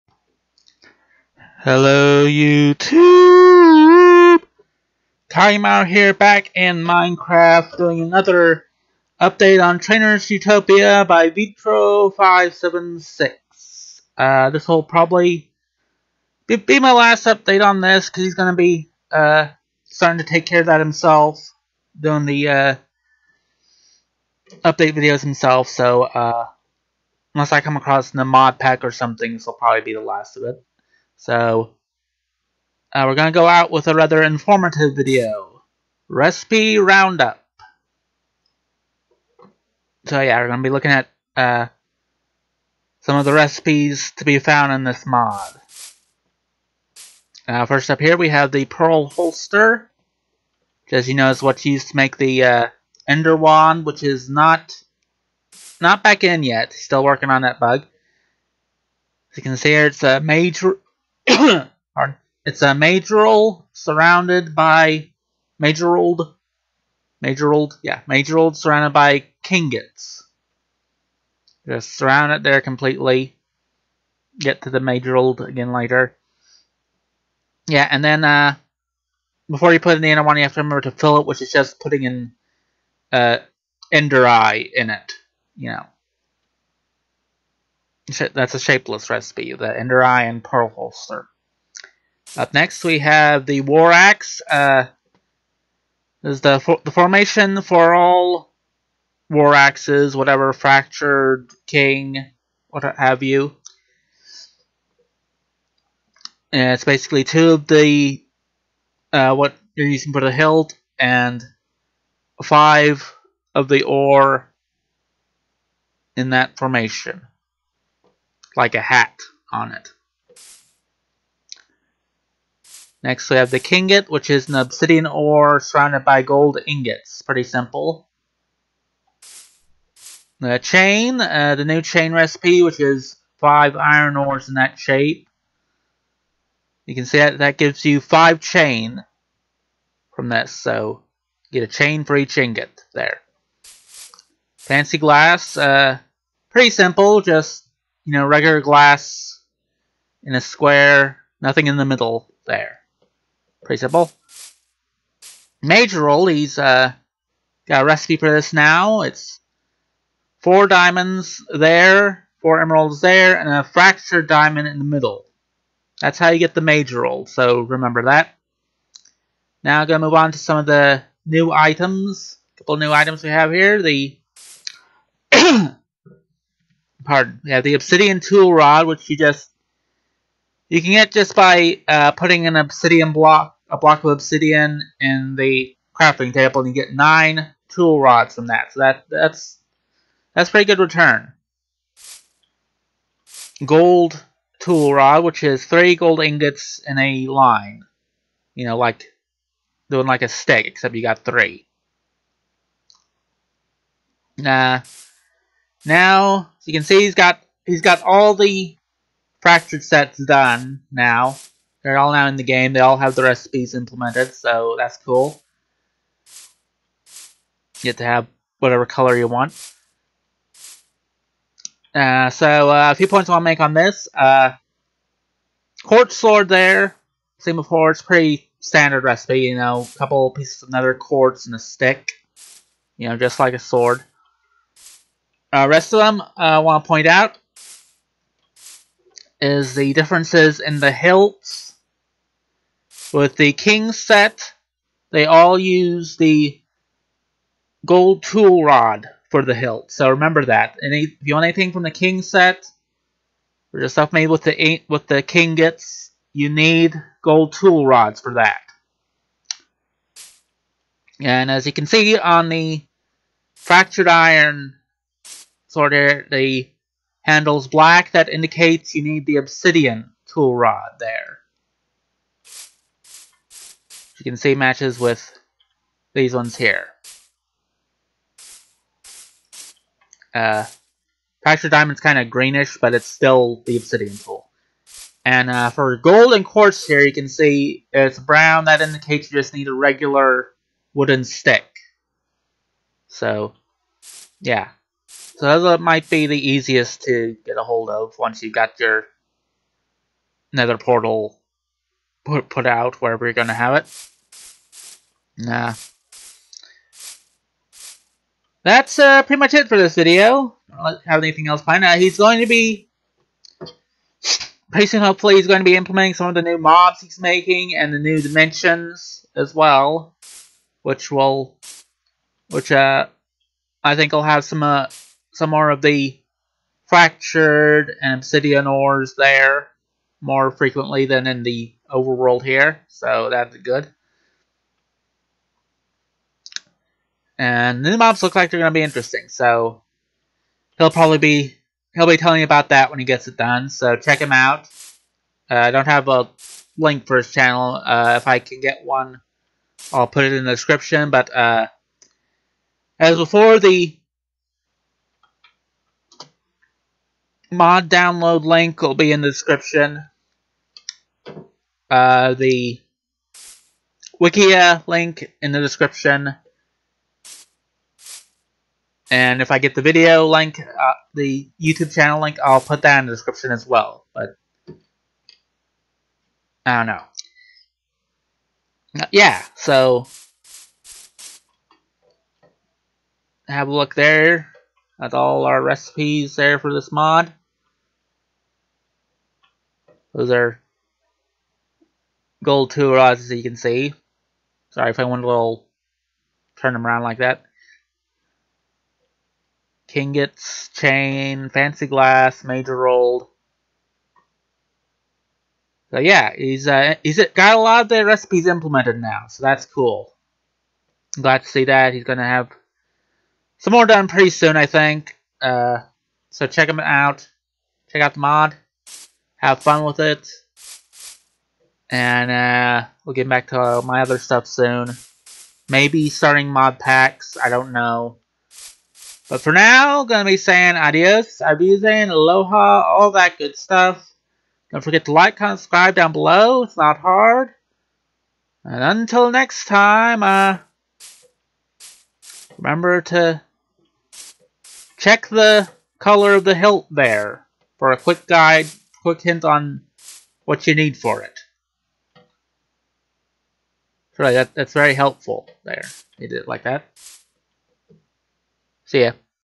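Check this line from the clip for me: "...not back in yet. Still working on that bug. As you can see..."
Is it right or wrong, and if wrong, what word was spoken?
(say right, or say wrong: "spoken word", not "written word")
right.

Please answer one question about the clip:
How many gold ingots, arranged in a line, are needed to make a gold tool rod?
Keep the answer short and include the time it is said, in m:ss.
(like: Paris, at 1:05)
3, at 3:15.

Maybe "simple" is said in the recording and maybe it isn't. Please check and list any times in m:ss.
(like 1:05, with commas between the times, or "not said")
2:07, 2:26, 2:33.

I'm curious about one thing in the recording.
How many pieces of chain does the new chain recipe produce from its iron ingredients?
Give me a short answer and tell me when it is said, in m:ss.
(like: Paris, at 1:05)
5, at 2:18.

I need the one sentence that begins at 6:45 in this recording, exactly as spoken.
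So yeah, he's uh, he's got a lot of the recipes implemented now, so that's cool.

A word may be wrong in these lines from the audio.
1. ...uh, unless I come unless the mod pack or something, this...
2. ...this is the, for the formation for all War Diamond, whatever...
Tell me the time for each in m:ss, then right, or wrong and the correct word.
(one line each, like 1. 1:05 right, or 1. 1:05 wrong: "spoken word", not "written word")
1. 0:26 wrong: "across", not "unless"
2. 1:36 wrong: "Axes", not "Diamond".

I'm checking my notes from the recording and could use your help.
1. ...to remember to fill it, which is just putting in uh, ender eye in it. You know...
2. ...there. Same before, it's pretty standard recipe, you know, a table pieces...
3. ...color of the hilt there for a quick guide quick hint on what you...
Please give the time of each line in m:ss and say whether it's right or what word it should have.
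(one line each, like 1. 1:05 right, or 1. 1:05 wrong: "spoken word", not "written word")
1. 1:20 right
2. 3:46 wrong: "couple", not "table"
3. 7:25 right.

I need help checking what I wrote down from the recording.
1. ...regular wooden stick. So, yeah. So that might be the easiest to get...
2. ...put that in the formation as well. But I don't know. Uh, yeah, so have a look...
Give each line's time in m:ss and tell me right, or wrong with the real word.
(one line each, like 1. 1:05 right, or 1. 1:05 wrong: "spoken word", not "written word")
1. 4:49 right
2. 6:12 wrong: "description", not "formation".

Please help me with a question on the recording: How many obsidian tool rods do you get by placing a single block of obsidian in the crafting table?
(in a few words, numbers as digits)
9.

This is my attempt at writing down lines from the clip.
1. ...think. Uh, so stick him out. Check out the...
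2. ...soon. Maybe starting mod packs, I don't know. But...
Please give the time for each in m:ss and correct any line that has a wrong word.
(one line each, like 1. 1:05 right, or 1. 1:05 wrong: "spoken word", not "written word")
1. 6:54 wrong: "check", not "stick"
2. 7:04 right.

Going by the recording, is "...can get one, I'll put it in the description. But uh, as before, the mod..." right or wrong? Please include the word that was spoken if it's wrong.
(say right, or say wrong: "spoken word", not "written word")
right.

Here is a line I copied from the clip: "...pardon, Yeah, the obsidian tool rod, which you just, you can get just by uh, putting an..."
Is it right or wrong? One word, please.
right.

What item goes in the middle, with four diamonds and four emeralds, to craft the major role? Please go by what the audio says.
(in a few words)
Fractured diamond.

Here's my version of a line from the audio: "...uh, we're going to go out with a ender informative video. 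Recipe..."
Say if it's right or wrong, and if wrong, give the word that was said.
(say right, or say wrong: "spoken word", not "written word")
wrong: "rather", not "ender".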